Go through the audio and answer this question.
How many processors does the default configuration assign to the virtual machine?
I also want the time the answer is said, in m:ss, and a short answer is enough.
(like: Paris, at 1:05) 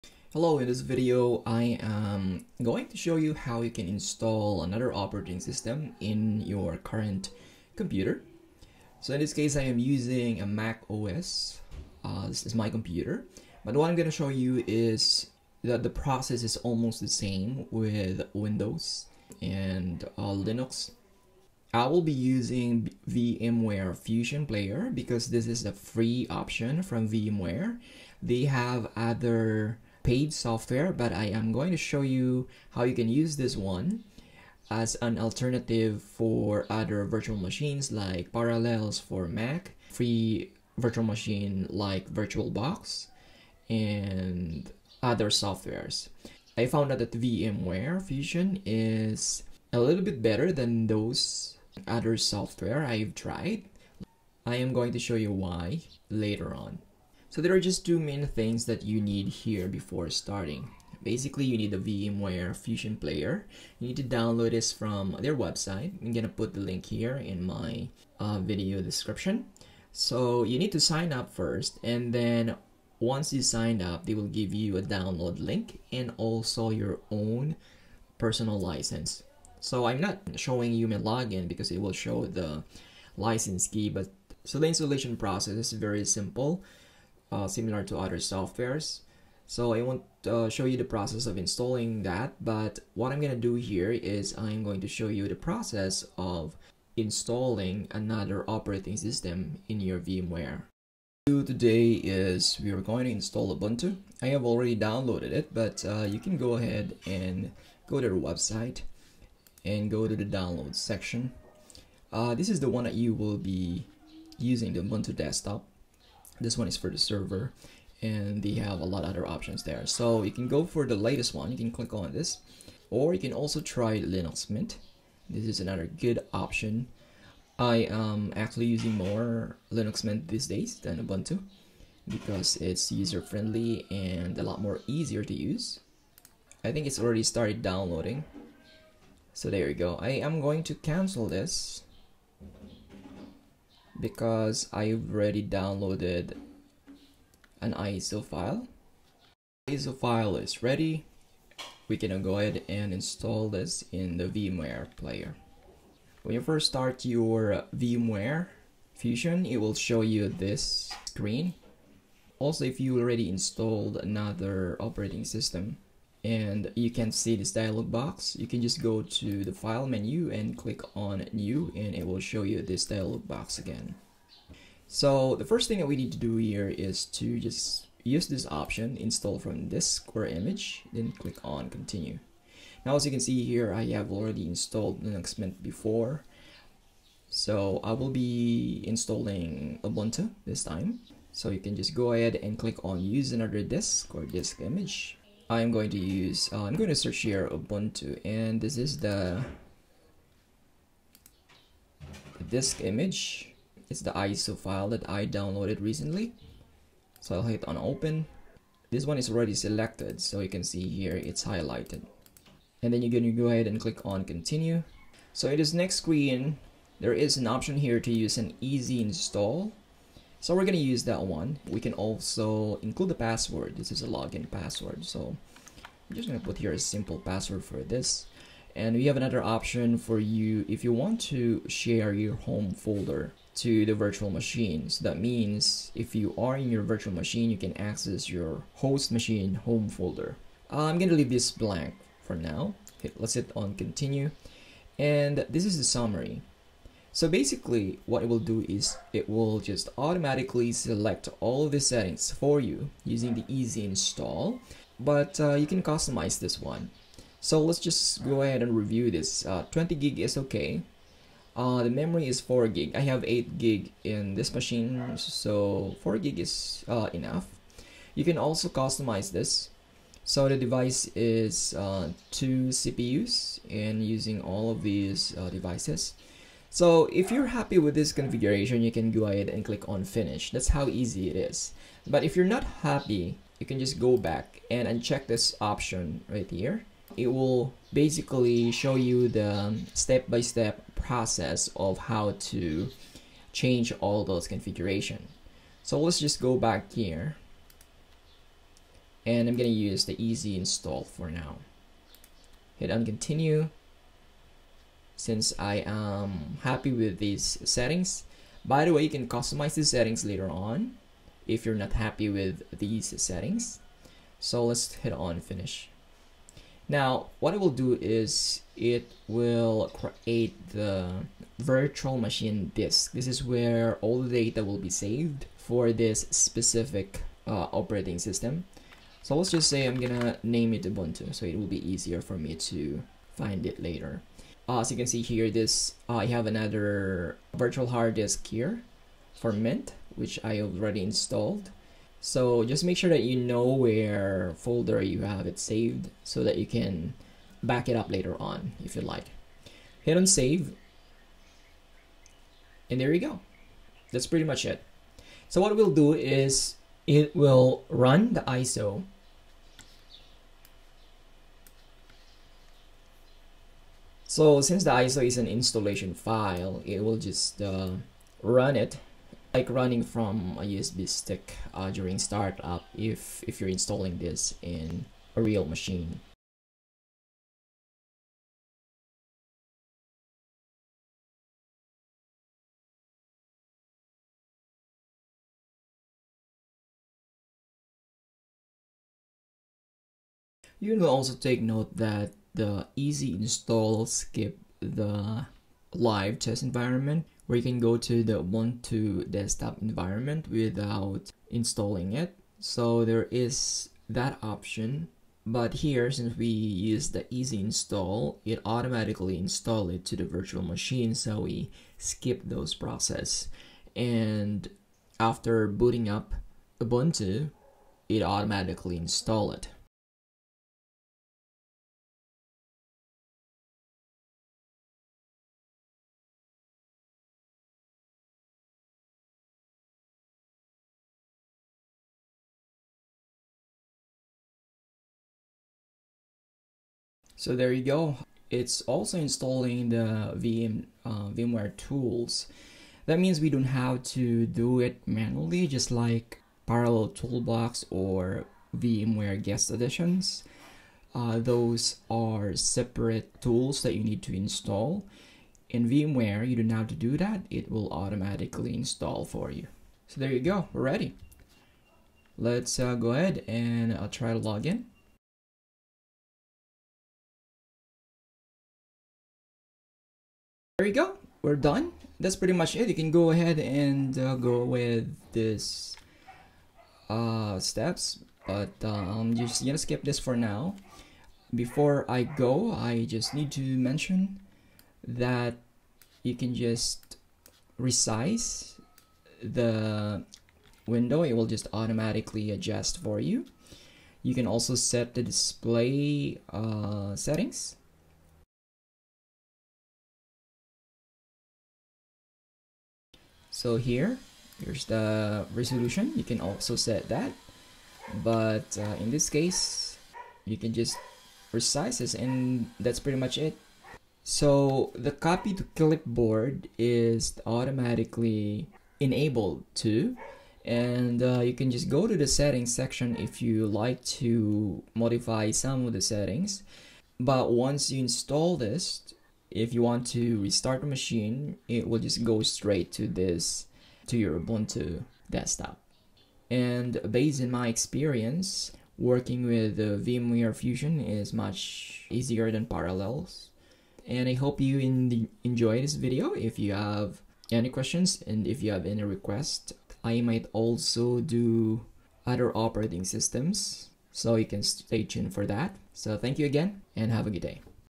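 2, at 4:32.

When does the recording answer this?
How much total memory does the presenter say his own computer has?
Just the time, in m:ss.
4:23.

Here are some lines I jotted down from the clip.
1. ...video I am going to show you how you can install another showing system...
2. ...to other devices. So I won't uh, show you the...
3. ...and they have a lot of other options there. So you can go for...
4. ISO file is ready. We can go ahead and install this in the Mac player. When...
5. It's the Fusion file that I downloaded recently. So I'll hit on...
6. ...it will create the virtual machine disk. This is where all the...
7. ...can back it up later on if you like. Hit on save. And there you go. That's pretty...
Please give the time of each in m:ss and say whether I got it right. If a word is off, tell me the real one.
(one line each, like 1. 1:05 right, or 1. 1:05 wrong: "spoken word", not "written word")
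1. 0:00 wrong: "operating", not "showing"
2. 1:27 wrong: "softwares", not "devices"
3. 1:58 right
4. 2:29 wrong: "VMware", not "Mac"
5. 3:23 wrong: "ISO", not "Fusion"
6. 5:18 right
7. 5:46 right.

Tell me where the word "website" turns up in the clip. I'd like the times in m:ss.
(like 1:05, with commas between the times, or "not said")
1:05, 1:48.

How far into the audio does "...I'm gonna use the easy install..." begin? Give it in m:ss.
4:59.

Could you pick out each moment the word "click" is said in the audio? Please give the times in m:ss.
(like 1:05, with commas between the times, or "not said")
2:01, 2:50, 3:01, 3:12, 3:33, 4:39.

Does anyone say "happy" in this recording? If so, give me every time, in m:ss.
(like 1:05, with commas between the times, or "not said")
4:37, 4:42, 5:06, 5:11.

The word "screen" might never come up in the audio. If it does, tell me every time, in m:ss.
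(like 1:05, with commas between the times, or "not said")
2:41, 3:35.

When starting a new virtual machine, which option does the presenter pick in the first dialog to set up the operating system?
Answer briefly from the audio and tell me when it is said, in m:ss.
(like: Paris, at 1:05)
install from disk or image, at 2:58.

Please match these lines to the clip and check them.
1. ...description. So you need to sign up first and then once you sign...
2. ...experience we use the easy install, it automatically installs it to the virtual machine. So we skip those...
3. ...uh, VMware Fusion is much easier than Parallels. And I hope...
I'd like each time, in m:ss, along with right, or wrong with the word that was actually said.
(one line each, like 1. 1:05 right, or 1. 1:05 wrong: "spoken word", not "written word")
1. 1:08 right
2. 6:46 wrong: "since", not "experience"
3. 8:59 right.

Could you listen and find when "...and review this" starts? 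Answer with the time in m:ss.
4:18.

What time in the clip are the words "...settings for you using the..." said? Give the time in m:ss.
4:11.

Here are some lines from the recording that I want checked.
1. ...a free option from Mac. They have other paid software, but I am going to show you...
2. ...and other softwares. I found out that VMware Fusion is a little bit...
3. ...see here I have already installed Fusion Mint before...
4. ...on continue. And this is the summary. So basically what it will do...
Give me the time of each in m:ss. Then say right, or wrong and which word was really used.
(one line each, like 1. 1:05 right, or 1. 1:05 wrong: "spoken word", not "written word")
1. 0:25 wrong: "VMware", not "Mac"
2. 0:43 right
3. 3:03 wrong: "Linux", not "Fusion"
4. 4:03 right.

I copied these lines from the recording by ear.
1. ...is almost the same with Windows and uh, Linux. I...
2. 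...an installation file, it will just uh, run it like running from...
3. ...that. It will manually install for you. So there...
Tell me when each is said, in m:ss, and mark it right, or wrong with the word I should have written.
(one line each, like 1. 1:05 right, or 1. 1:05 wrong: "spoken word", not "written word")
1. 0:16 right
2. 6:05 right
3. 7:37 wrong: "automatically", not "manually".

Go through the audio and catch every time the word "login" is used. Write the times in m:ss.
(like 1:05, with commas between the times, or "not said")
1:20, 3:44.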